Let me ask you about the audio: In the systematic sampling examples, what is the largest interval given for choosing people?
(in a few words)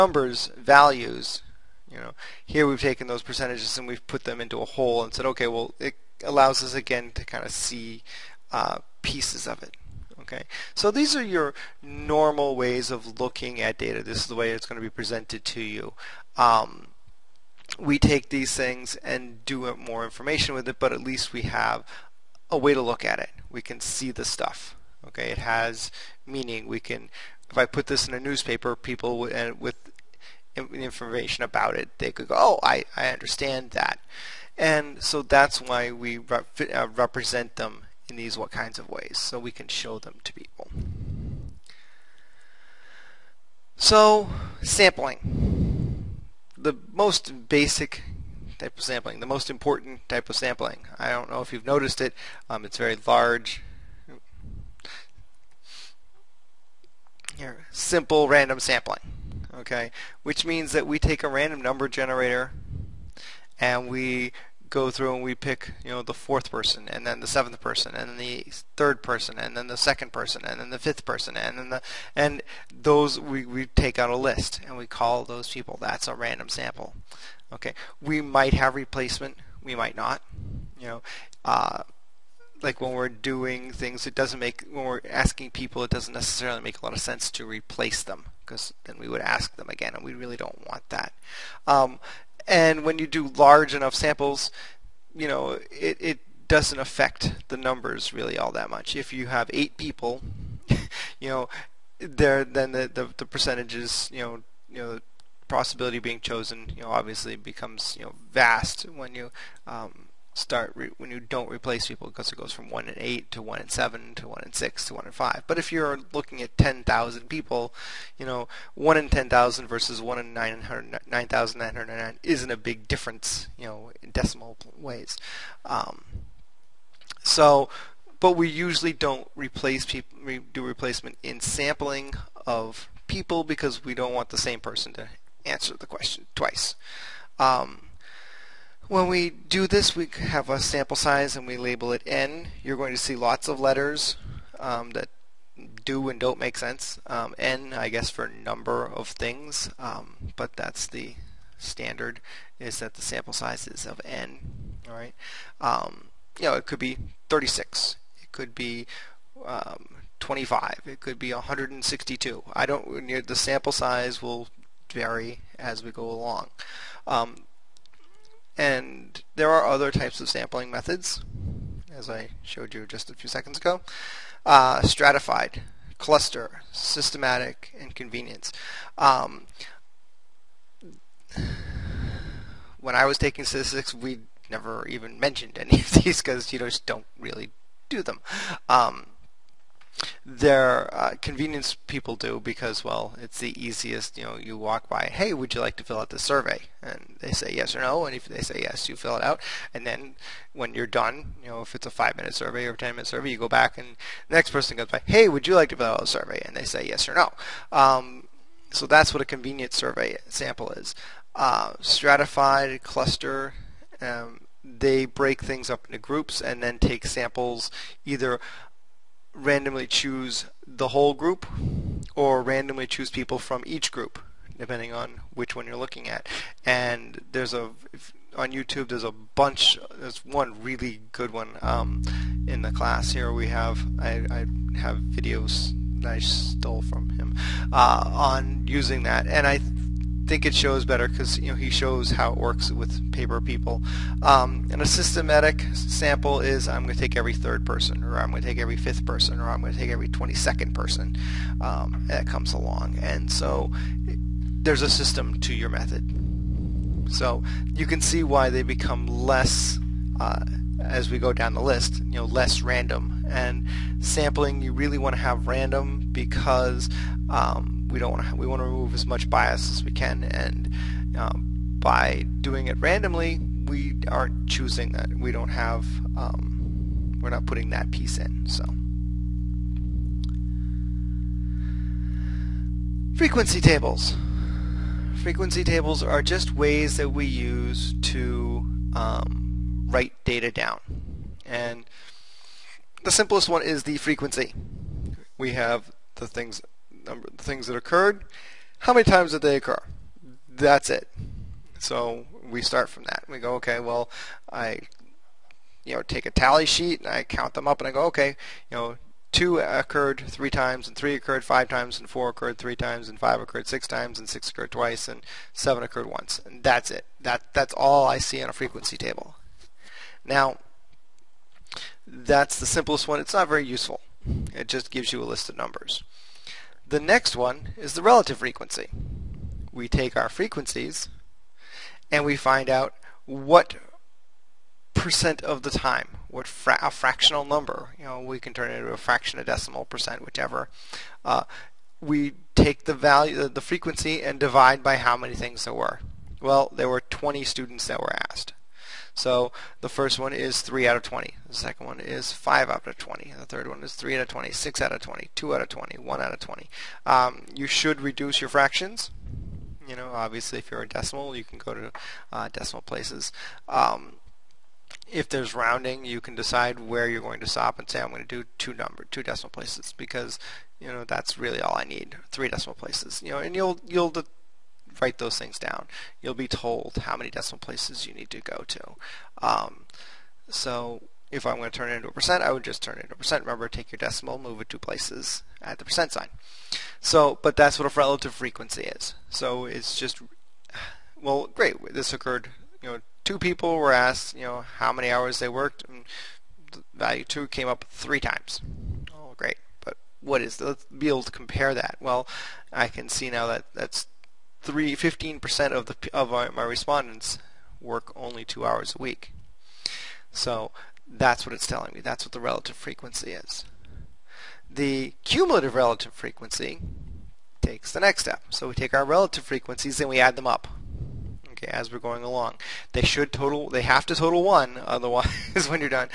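every 22nd person.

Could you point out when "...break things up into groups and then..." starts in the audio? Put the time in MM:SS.
03:35.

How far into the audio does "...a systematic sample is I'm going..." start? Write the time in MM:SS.
04:04.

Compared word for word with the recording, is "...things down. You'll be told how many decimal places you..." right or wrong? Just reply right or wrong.
right.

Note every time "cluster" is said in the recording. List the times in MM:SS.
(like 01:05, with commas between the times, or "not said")
02:55, 03:32.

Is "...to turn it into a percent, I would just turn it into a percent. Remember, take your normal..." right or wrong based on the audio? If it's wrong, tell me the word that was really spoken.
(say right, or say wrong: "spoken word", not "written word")
wrong: "decimal", not "normal".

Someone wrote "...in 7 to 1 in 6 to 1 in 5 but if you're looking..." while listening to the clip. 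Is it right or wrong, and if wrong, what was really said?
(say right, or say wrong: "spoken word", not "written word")
right.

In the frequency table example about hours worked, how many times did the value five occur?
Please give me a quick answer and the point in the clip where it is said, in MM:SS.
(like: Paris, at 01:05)
6, at 05:13.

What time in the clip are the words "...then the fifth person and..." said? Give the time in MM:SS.
01:10.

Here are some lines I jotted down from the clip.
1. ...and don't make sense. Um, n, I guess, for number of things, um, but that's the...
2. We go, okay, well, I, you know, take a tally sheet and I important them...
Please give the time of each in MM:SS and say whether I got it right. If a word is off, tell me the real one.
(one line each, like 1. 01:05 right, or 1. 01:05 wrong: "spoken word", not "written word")
1. 02:26 right
2. 05:03 wrong: "count", not "important".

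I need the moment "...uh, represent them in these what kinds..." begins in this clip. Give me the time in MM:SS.
00:36.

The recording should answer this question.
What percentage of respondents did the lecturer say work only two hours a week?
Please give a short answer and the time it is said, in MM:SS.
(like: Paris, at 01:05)
15%, at 06:45.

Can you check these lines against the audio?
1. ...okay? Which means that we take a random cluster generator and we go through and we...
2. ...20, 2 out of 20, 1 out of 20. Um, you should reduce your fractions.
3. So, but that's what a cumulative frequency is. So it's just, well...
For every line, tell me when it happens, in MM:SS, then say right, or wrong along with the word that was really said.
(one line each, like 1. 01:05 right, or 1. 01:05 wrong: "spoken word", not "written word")
1. 00:59 wrong: "number", not "cluster"
2. 05:55 right
3. 06:27 wrong: "relative", not "cumulative".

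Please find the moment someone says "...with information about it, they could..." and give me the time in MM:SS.
00:29.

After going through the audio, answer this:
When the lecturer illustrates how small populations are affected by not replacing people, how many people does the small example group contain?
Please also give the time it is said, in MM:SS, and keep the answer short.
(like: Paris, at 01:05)
8, at 01:39.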